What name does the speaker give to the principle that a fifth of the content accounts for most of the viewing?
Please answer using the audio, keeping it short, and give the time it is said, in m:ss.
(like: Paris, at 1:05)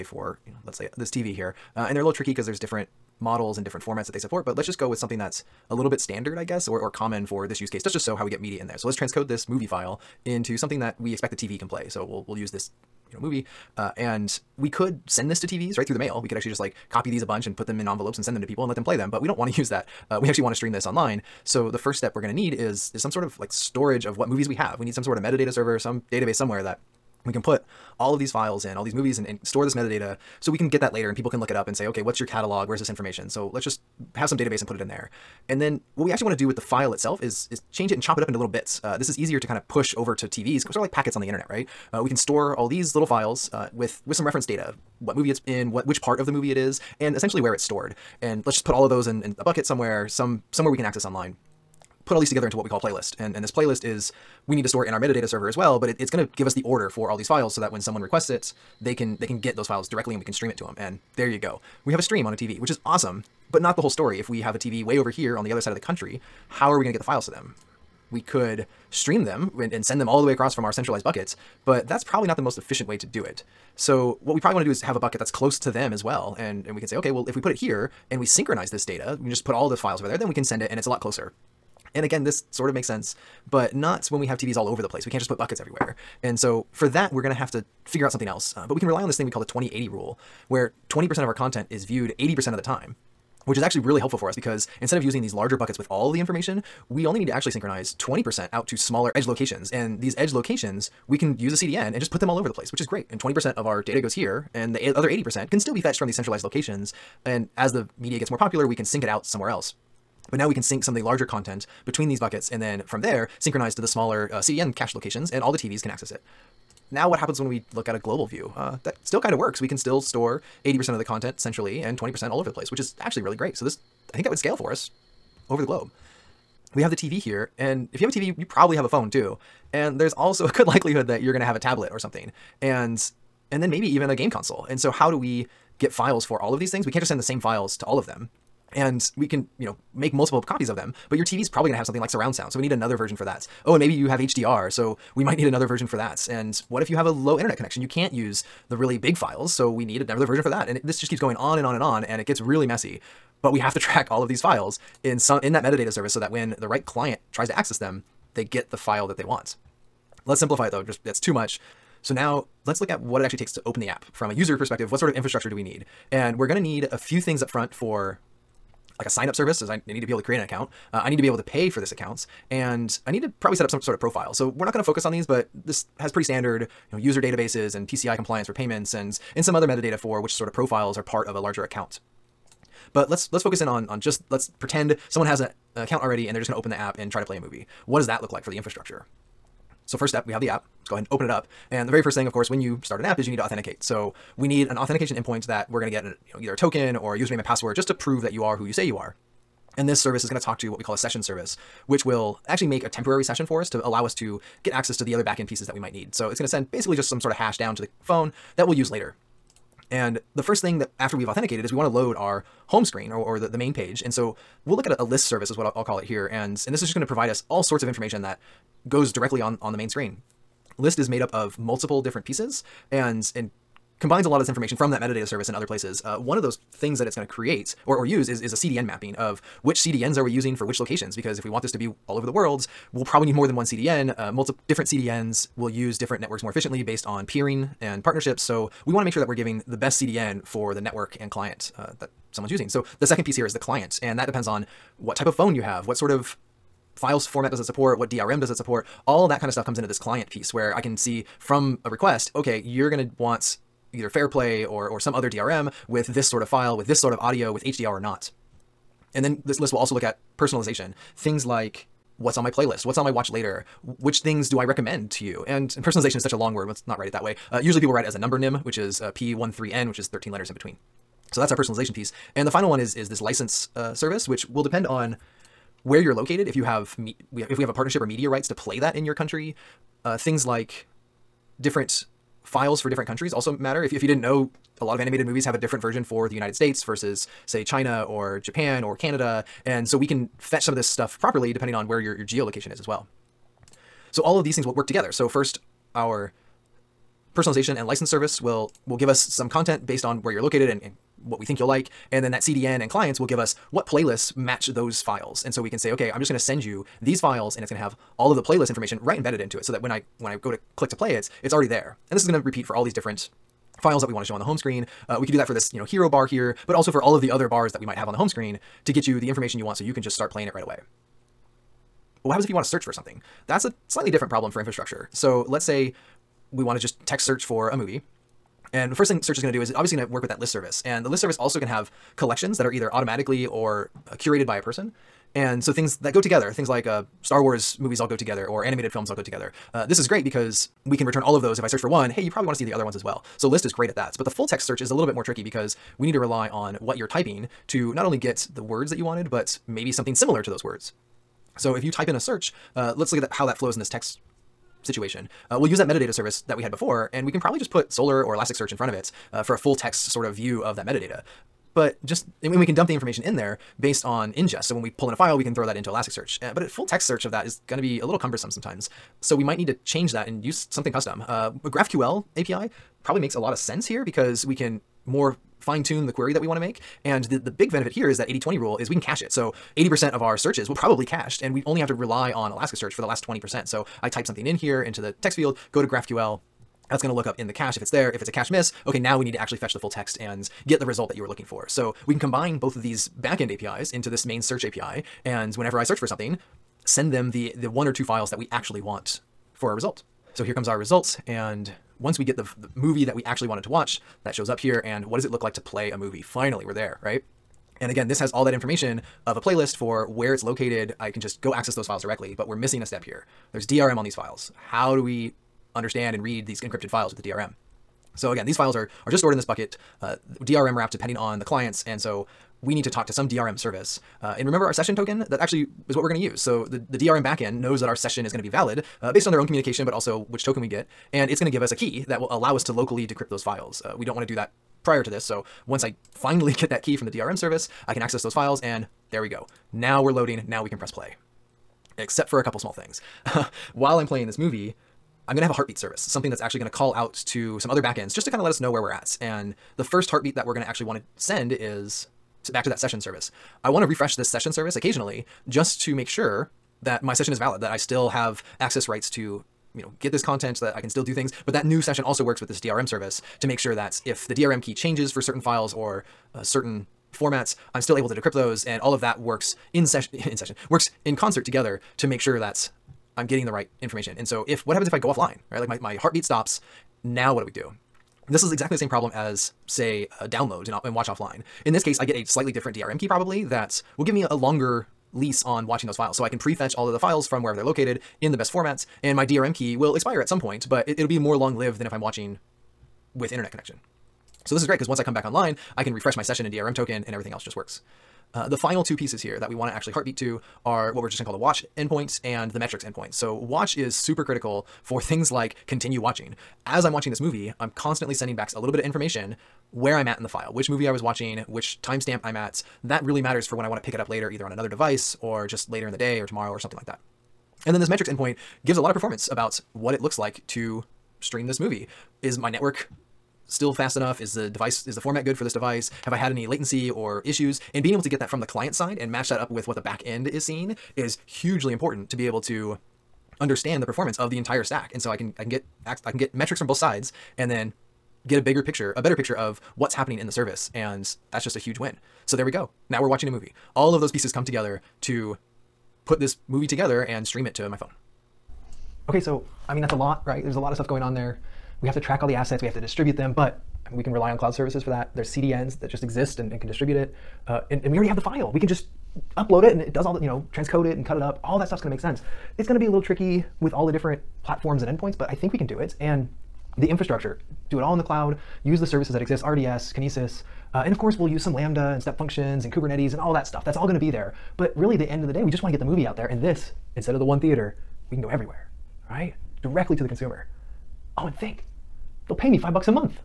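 2080 rule, at 1:29.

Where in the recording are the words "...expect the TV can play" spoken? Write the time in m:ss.
0:11.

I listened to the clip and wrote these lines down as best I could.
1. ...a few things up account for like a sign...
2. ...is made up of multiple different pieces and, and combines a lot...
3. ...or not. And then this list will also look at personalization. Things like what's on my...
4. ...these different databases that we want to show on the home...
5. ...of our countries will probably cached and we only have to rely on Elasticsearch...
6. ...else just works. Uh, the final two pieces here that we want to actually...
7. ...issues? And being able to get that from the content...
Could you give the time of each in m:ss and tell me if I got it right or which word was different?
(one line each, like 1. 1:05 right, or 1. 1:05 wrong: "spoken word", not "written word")
1. 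2:46 wrong: "front", not "account"
2. 3:40 right
3. 4:17 right
4. 5:12 wrong: "files", not "databases"
5. 6:20 wrong: "searches", not "countries"
6. 8:17 right
7. 8:47 wrong: "client", not "content".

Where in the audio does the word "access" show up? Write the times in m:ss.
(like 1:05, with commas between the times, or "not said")
0:50, 1:55, 2:37, 3:24, 6:51, 7:18, 7:38.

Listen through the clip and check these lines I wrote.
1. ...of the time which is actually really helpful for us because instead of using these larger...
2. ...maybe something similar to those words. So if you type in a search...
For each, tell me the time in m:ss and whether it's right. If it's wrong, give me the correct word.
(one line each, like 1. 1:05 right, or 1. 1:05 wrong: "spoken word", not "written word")
1. 1:32 right
2. 5:49 right.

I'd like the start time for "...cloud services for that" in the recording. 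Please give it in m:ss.
9:14.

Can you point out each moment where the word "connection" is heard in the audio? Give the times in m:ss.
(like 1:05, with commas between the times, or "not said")
2:27, 8:13.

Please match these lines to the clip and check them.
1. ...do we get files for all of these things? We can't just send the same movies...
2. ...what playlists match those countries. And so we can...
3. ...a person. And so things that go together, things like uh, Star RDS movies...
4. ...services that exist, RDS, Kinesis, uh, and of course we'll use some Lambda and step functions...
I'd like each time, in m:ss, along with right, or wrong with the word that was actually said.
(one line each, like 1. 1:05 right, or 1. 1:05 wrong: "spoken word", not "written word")
1. 2:15 wrong: "files", not "movies"
2. 5:03 wrong: "files", not "countries"
3. 5:34 wrong: "Wars", not "RDS"
4. 9:28 right.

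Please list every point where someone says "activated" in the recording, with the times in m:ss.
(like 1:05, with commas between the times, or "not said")
not said.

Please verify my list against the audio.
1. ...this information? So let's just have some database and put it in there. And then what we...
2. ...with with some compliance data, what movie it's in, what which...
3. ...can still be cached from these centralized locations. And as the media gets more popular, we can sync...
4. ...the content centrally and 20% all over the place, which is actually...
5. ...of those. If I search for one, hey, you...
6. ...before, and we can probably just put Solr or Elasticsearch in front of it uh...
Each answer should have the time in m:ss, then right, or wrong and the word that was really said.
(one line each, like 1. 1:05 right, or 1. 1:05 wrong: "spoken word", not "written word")
1. 0:32 right
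2. 0:43 wrong: "reference", not "compliance"
3. 1:45 wrong: "fetched", not "cached"
4. 2:00 right
5. 5:41 right
6. 5:56 right.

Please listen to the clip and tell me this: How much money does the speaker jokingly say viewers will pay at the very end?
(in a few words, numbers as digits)
5 bucks.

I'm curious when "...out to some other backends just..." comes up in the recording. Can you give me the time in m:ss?
7:26.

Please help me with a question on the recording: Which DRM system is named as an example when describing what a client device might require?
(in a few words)
FairPlay.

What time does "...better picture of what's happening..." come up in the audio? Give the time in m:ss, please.
8:59.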